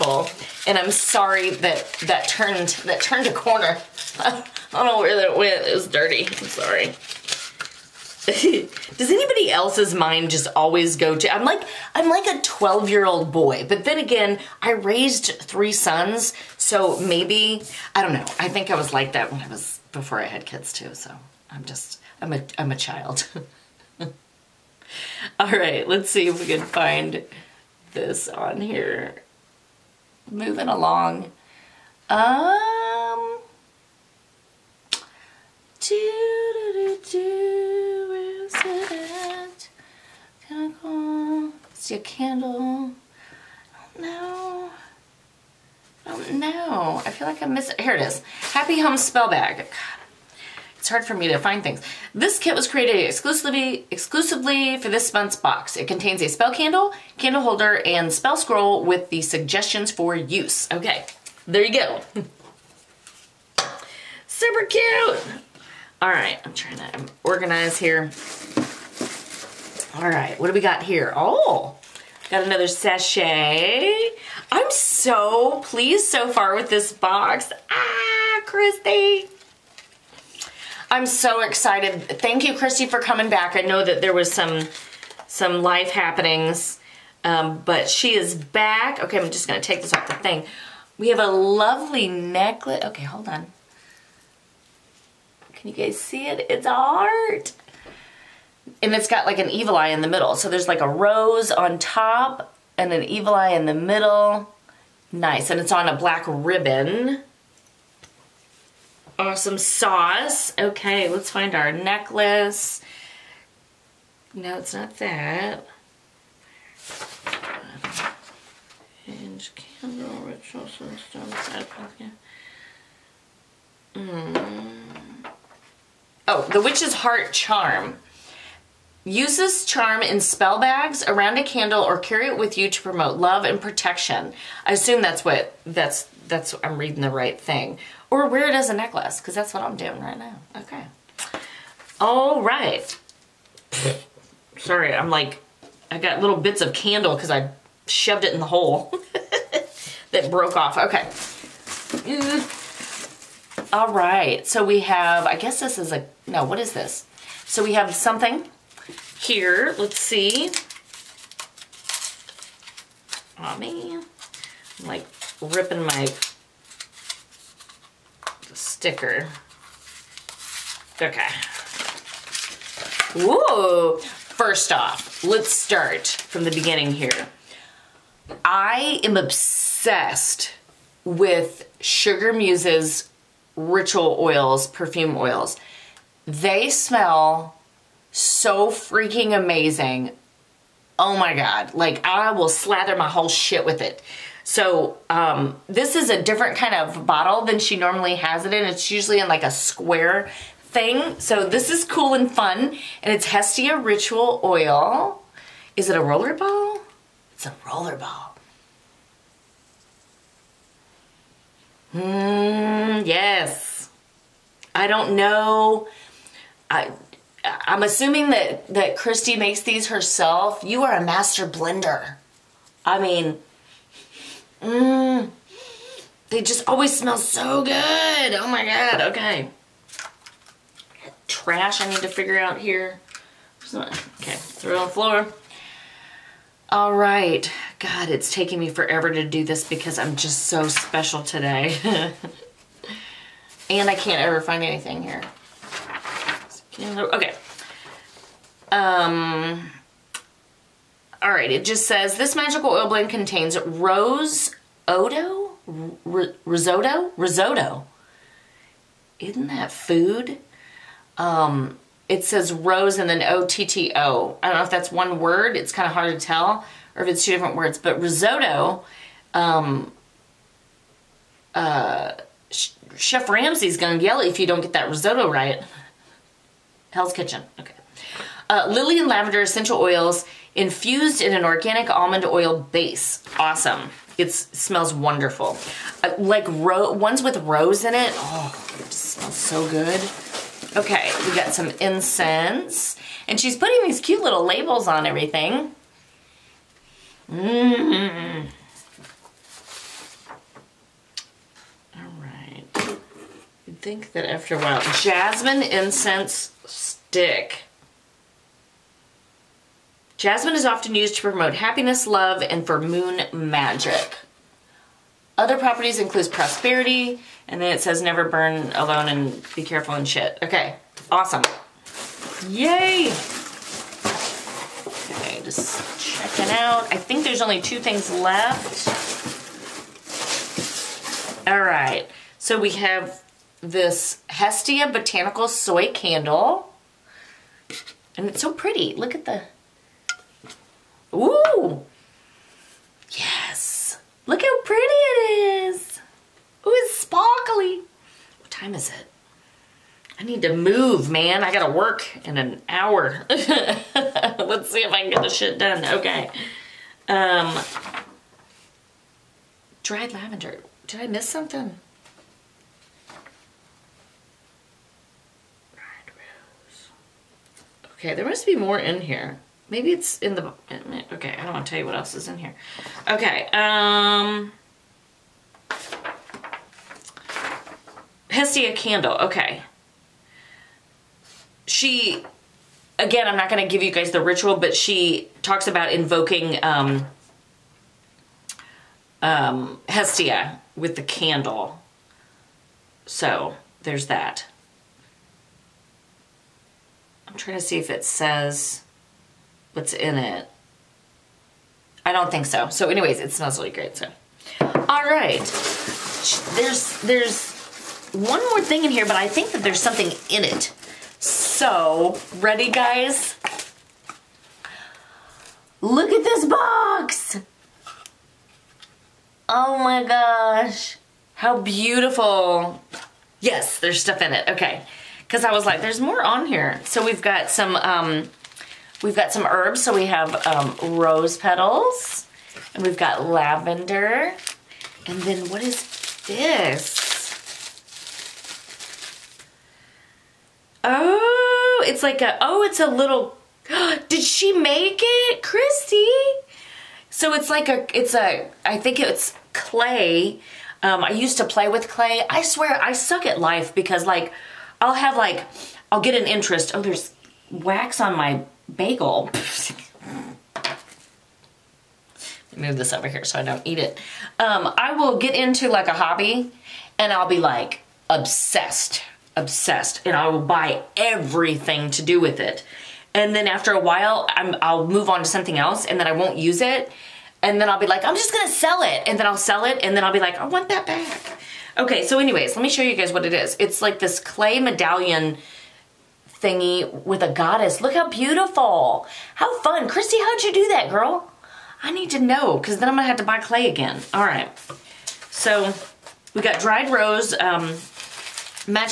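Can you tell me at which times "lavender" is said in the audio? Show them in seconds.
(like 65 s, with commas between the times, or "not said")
279 s, 360 s, 433 s.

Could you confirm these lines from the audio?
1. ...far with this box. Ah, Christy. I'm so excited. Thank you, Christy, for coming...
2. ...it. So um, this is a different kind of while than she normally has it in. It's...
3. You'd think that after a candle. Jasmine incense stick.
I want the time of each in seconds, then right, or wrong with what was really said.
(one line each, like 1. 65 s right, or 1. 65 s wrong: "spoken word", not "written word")
1. 76 s right
2. 193 s wrong: "bottle", not "while"
3. 303 s wrong: "while", not "candle".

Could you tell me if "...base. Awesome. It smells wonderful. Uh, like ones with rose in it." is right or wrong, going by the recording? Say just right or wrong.
right.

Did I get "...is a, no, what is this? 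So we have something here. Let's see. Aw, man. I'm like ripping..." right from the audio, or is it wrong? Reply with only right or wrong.
right.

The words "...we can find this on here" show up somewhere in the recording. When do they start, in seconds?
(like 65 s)
26 s.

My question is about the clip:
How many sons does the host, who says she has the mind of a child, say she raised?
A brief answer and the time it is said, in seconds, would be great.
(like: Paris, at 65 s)
3, at 15 s.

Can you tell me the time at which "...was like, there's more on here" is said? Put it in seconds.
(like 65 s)
425 s.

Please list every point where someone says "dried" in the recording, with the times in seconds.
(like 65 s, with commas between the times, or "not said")
359 s, 496 s.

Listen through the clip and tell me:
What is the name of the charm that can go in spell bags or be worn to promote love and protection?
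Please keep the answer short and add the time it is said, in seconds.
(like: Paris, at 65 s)
The witch's heart charm, at 126 s.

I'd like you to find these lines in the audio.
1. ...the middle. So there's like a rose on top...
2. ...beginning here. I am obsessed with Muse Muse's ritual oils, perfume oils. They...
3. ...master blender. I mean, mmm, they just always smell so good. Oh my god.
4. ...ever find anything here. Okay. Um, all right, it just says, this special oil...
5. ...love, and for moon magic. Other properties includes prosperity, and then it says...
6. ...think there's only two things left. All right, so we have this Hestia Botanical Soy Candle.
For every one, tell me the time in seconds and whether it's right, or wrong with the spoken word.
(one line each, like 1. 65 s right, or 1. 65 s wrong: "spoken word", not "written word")
1. 99 s right
2. 176 s wrong: "Sugar", not "Muse"
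3. 221 s right
4. 244 s wrong: "magical", not "special"
5. 312 s right
6. 326 s right.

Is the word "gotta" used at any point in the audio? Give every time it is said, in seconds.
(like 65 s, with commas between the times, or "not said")
351 s.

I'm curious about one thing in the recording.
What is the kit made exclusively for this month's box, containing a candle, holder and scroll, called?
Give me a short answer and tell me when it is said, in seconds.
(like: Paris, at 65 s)
Happy Home Spell Bag, at 48 s.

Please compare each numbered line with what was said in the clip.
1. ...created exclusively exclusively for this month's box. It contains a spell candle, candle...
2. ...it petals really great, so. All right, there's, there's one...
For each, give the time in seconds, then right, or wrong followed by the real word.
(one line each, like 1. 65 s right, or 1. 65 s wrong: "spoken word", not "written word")
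1. 52 s right
2. 403 s wrong: "smells", not "petals".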